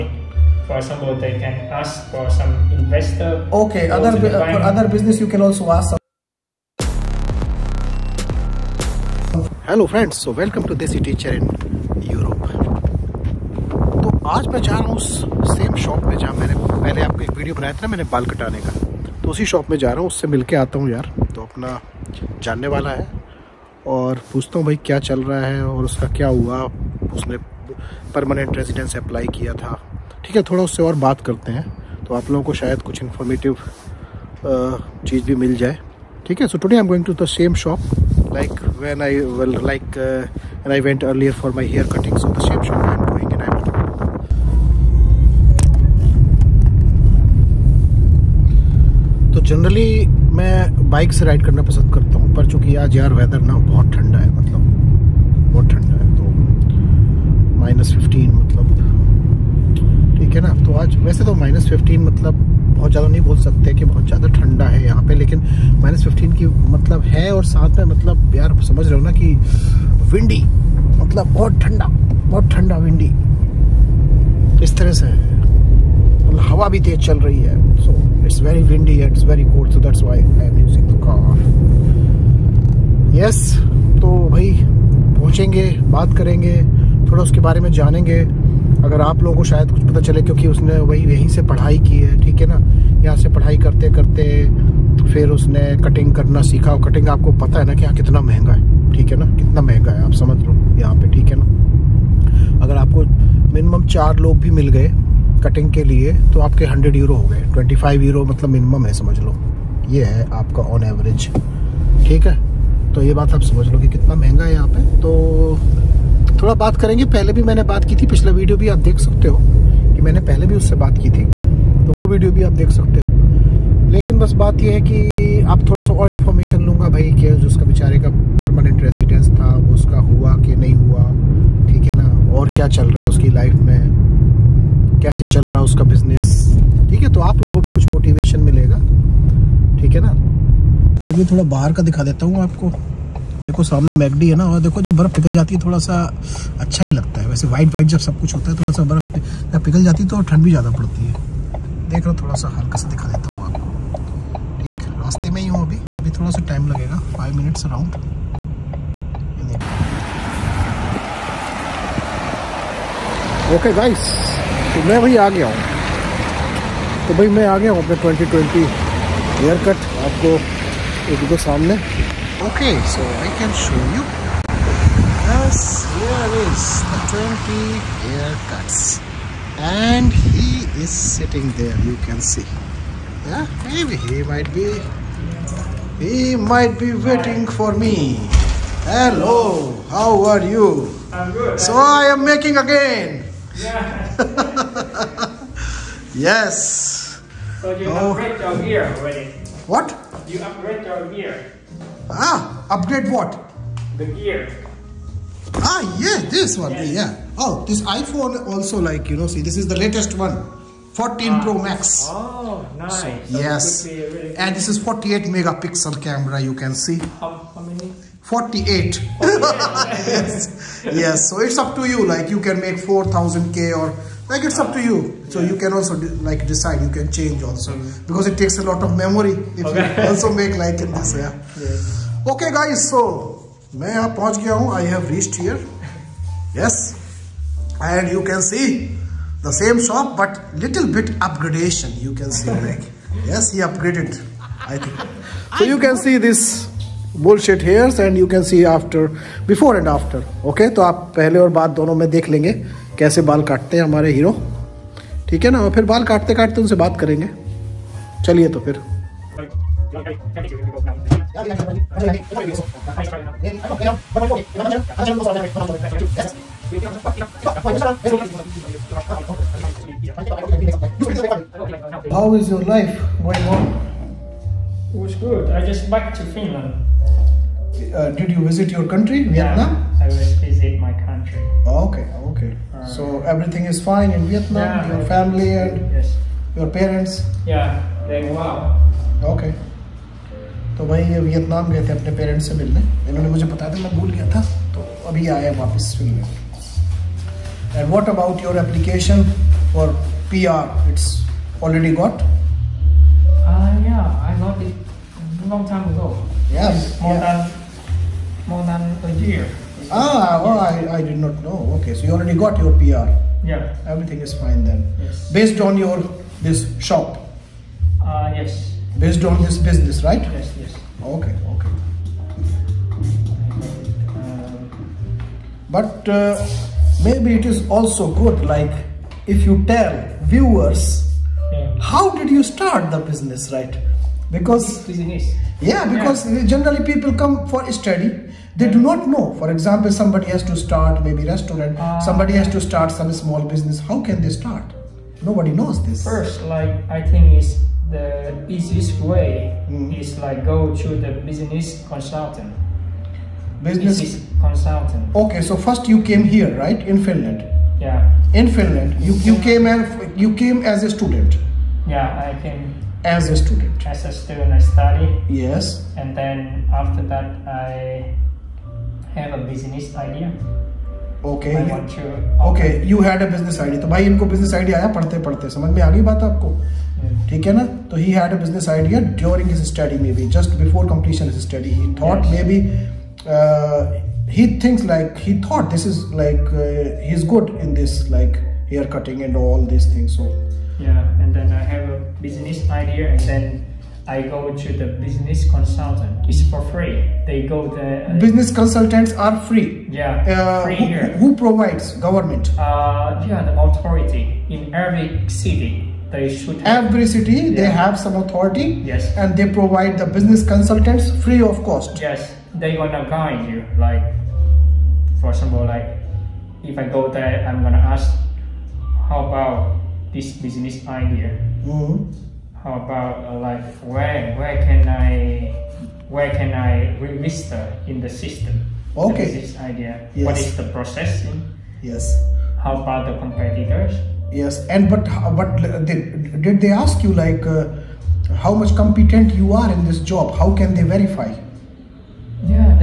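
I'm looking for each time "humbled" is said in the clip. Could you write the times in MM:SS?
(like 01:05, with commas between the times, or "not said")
not said.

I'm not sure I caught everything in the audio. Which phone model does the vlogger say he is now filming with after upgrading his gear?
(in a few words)
iPhone 14 Pro Max.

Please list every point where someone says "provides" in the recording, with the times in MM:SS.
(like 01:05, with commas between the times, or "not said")
06:41, 06:49.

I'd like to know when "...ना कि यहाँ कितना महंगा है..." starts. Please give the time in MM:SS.
01:37.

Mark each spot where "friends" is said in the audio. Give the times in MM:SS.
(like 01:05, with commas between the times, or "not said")
00:09.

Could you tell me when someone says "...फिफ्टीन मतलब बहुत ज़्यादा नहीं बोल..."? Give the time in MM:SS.
01:01.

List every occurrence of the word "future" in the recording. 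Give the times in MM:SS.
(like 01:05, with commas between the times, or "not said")
not said.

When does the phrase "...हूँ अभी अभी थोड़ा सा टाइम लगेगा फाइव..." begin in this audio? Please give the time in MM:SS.
02:35.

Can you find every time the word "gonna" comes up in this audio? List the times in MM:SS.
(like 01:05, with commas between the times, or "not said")
06:52, 06:57.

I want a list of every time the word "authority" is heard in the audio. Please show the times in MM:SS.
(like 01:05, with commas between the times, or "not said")
06:43, 06:48.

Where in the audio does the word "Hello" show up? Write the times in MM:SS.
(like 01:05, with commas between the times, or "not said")
00:09.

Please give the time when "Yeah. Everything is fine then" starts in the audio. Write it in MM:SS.
05:13.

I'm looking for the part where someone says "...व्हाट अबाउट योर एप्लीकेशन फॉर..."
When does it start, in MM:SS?
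04:57.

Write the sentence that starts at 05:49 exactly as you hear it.
is like go to the business consultant.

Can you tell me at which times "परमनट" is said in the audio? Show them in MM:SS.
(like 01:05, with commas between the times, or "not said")
00:28, 02:08.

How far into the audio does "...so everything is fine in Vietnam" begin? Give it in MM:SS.
04:42.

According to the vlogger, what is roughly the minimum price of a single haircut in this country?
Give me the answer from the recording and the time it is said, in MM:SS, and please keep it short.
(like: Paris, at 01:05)
25 euros, at 01:47.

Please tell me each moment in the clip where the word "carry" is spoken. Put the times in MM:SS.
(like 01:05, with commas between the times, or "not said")
not said.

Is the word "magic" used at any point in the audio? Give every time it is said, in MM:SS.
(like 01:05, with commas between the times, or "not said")
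not said.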